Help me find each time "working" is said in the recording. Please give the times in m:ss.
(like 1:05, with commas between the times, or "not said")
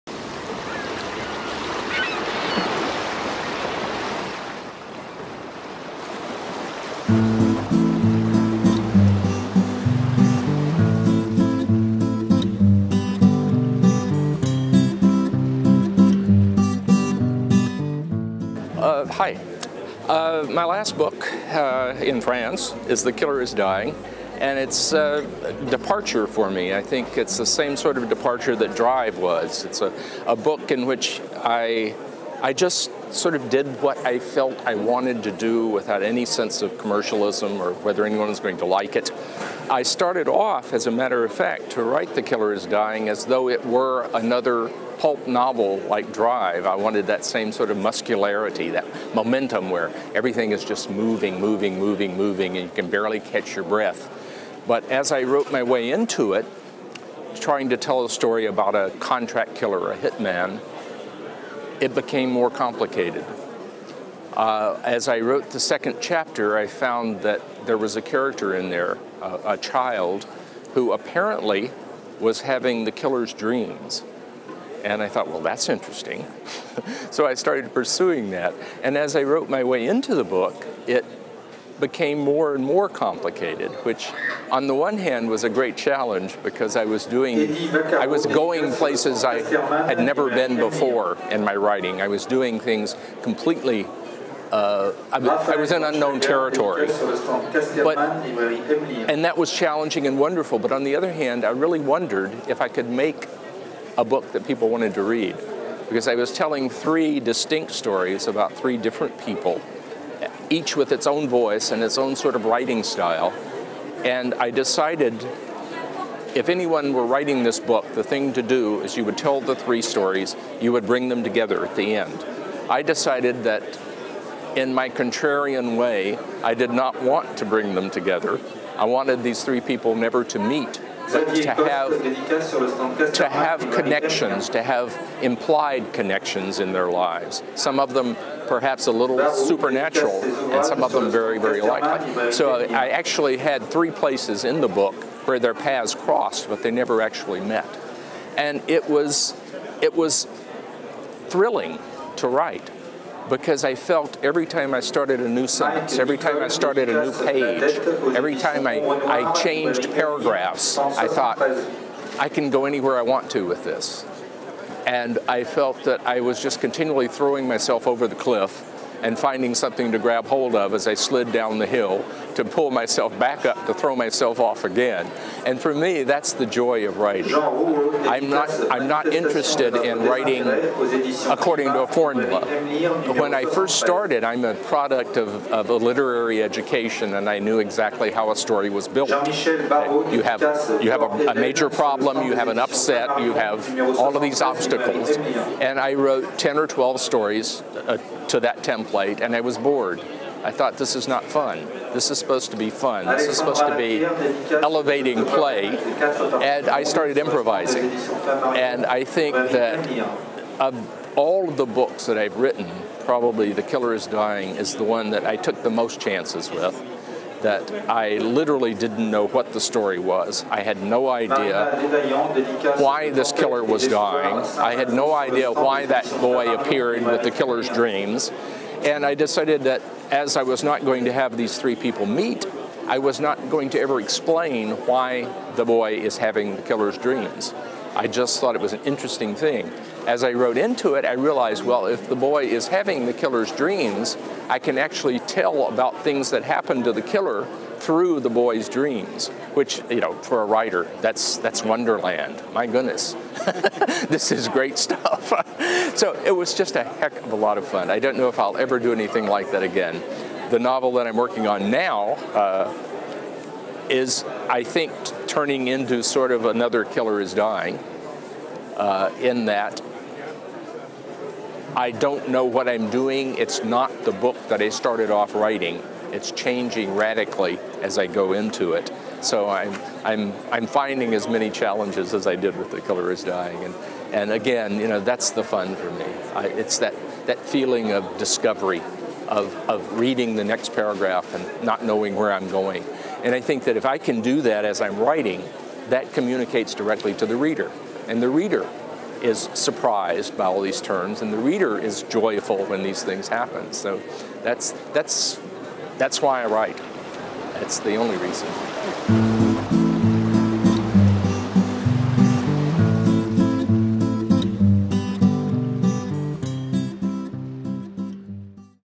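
4:21.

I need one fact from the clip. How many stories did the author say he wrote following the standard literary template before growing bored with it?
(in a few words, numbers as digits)
10 or 12.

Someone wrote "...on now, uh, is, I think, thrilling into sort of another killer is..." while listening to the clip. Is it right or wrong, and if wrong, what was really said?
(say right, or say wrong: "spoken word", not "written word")
wrong: "turning", not "thrilling".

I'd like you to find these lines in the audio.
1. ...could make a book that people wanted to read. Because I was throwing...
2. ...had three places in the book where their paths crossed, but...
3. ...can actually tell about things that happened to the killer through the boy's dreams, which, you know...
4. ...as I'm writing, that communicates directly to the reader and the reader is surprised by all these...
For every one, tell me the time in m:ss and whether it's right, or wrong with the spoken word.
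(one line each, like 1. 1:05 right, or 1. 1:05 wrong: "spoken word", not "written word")
1. 1:42 wrong: "telling", not "throwing"
2. 2:23 right
3. 4:04 right
4. 4:54 right.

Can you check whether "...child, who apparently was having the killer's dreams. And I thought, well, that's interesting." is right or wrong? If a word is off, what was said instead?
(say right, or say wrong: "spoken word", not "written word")
right.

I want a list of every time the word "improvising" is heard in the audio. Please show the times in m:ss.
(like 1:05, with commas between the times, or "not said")
3:27.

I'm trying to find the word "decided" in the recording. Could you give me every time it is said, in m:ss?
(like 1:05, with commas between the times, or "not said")
1:54, 2:02, 3:49.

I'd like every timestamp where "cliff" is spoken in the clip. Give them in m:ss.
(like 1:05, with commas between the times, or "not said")
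2:48.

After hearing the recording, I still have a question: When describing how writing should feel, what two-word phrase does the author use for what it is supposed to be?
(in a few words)
Elevating play.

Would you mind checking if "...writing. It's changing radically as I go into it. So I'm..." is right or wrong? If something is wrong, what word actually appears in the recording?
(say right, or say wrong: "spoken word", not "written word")
right.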